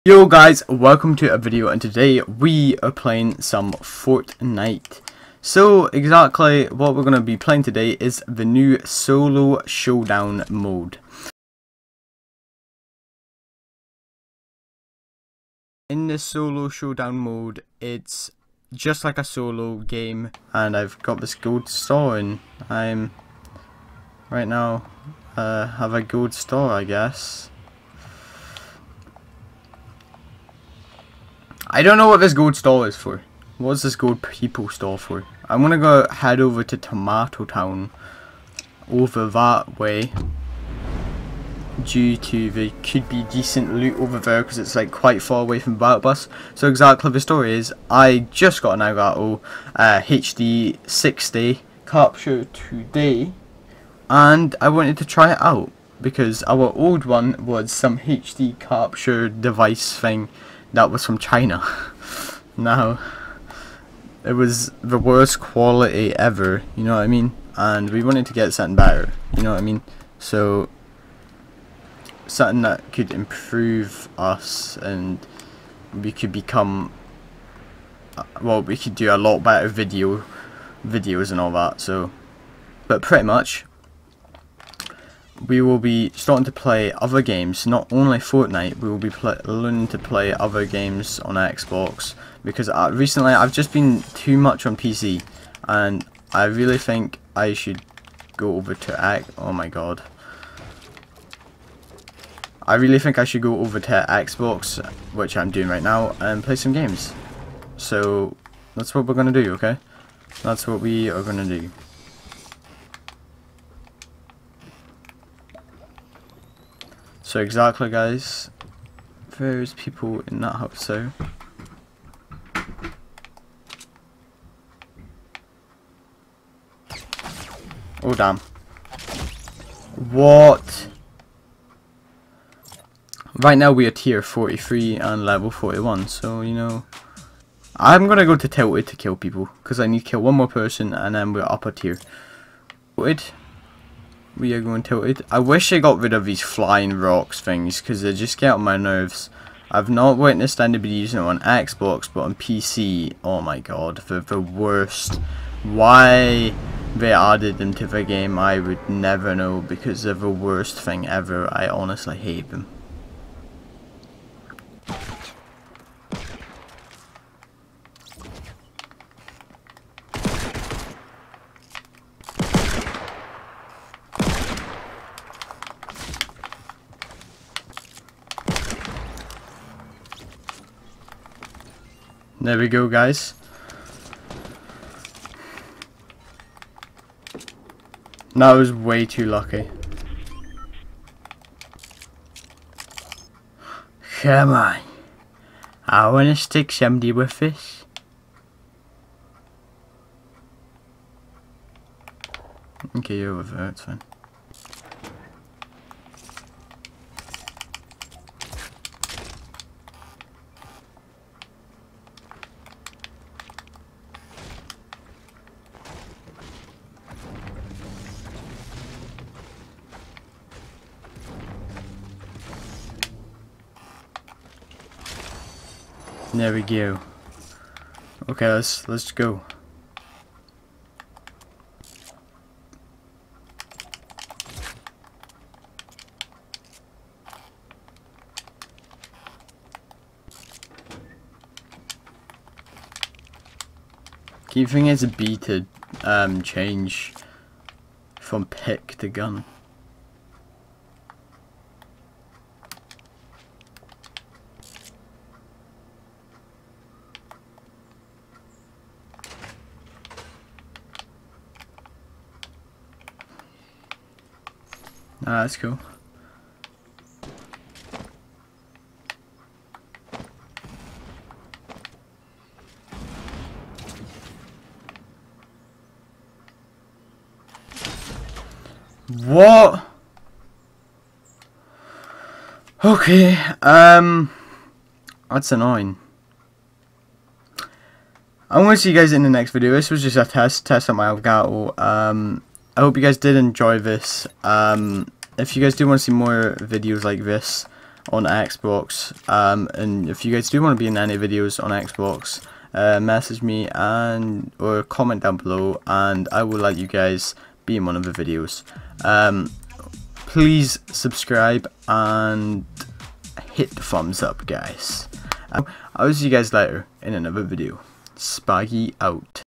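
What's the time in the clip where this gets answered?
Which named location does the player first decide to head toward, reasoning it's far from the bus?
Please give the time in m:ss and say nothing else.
0:36.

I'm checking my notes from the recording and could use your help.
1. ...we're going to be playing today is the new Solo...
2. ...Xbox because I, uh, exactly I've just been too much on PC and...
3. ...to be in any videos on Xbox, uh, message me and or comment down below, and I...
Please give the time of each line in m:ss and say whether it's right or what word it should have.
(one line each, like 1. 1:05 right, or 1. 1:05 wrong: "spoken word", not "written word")
1. 0:06 right
2. 1:31 wrong: "recently", not "exactly"
3. 5:00 right.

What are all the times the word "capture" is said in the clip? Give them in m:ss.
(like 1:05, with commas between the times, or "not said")
0:51, 0:58.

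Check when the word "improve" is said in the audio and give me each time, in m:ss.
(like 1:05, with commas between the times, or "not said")
1:13.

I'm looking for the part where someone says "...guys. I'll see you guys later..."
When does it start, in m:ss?
5:14.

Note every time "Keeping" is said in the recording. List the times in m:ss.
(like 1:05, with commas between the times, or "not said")
4:04.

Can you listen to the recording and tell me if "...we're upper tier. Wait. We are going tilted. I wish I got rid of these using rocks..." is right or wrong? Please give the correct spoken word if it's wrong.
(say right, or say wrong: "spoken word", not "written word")
wrong: "flying", not "using".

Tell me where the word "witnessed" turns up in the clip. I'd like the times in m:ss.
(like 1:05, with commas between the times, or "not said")
2:30.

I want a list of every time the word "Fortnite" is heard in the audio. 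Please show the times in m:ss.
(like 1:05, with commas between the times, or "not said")
0:03, 1:28.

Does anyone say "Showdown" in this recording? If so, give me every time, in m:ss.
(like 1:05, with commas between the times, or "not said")
0:09, 0:16.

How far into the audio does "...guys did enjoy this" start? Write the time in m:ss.
4:53.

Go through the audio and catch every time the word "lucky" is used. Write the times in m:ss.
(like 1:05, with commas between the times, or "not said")
3:09.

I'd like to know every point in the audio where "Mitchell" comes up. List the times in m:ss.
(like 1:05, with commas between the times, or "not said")
not said.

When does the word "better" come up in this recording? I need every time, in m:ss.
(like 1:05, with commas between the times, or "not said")
1:08, 1:19.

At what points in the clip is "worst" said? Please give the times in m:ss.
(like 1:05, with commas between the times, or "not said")
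1:04, 2:34, 2:40.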